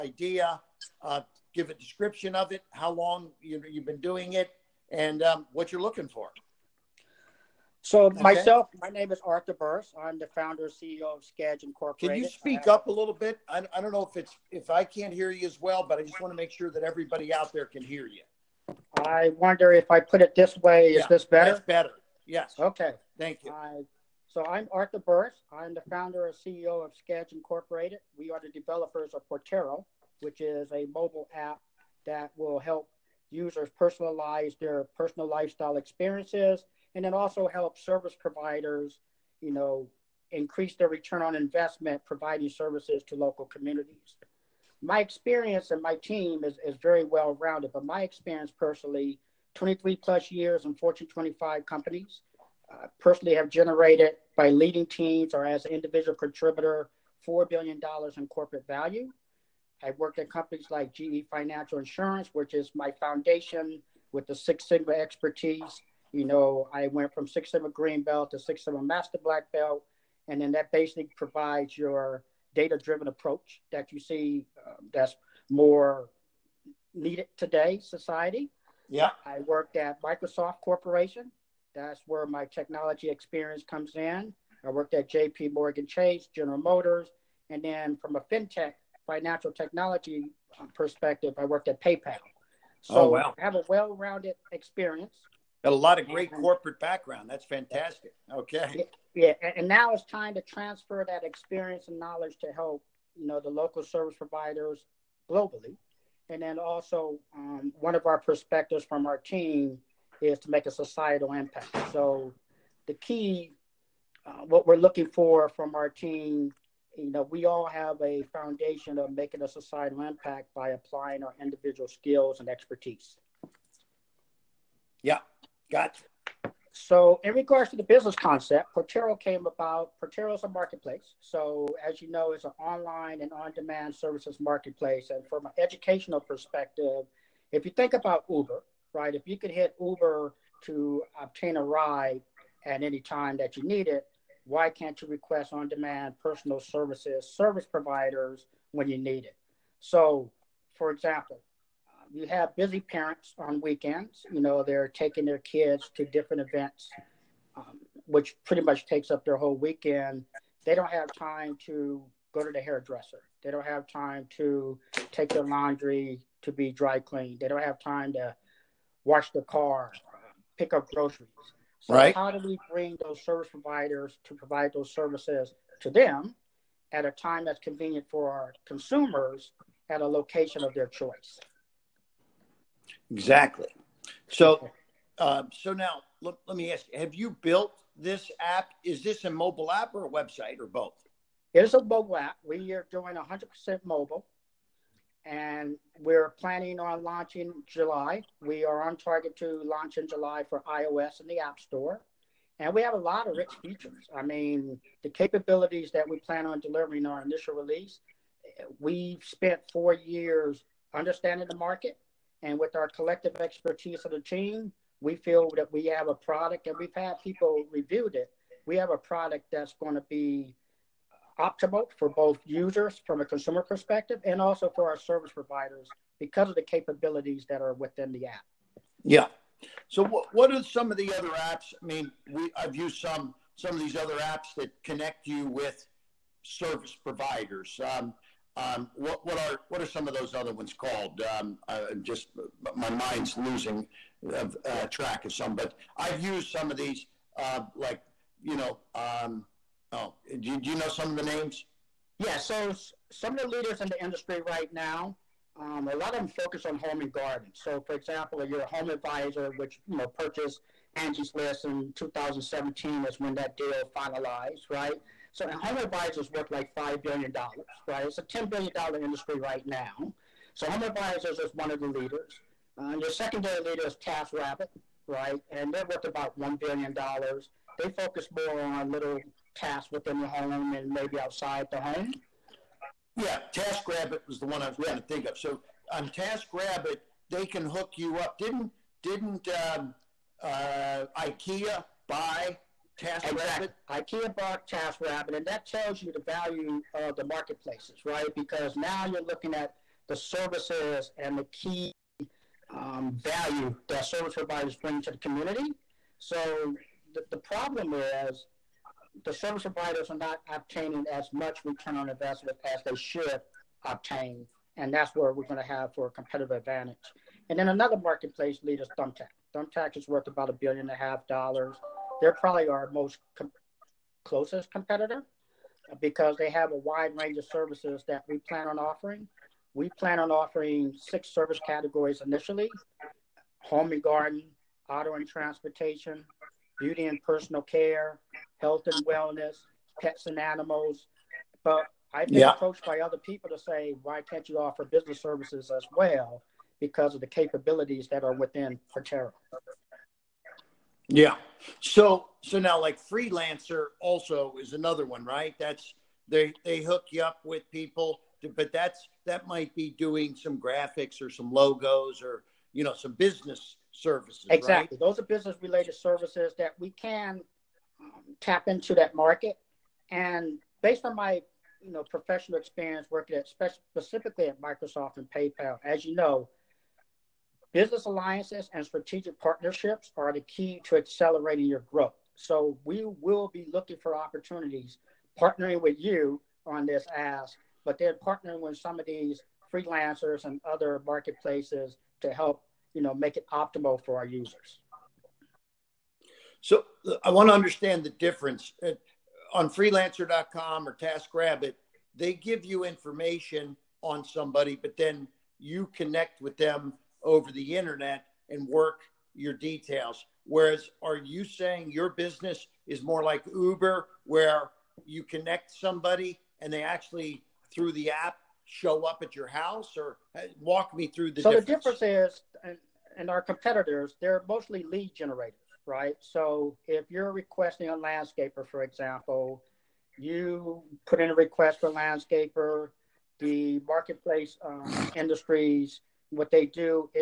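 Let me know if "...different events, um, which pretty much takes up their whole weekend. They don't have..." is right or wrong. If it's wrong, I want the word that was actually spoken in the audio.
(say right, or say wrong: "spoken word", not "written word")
right.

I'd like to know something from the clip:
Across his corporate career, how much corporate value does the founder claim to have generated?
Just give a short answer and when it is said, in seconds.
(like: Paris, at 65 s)
$4 billion, at 57 s.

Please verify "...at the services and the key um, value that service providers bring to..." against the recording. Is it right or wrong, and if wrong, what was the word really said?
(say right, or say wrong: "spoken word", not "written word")
right.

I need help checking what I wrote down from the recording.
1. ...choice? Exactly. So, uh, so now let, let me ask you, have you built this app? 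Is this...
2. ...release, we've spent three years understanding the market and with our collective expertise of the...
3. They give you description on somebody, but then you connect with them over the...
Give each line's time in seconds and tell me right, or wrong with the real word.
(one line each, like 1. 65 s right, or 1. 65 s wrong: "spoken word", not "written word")
1. 180 s right
2. 207 s wrong: "four", not "three"
3. 402 s wrong: "information", not "description".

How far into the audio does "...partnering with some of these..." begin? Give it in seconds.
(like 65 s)
388 s.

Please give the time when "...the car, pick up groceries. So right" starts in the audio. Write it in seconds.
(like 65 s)
169 s.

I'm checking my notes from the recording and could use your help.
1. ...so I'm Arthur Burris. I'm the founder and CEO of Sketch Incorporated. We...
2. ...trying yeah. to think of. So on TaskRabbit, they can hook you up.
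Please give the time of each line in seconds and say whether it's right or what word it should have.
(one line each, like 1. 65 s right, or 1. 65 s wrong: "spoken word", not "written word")
1. 24 s right
2. 284 s right.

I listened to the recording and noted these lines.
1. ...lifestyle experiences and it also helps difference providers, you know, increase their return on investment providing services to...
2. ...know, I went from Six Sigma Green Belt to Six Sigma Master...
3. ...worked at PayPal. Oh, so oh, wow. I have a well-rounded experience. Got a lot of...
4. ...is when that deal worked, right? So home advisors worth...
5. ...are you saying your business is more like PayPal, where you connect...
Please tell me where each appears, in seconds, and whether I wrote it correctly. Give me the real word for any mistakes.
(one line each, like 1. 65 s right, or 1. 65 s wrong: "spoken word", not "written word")
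1. 35 s wrong: "service", not "difference"
2. 66 s right
3. 91 s right
4. 263 s wrong: "finalized", not "worked"
5. 411 s wrong: "Uber", not "PayPal".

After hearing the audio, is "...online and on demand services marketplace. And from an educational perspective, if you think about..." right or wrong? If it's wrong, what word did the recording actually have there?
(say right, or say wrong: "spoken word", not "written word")
right.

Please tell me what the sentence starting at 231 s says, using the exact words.
I mean, we I've used some some of these other apps that connect you with service providers.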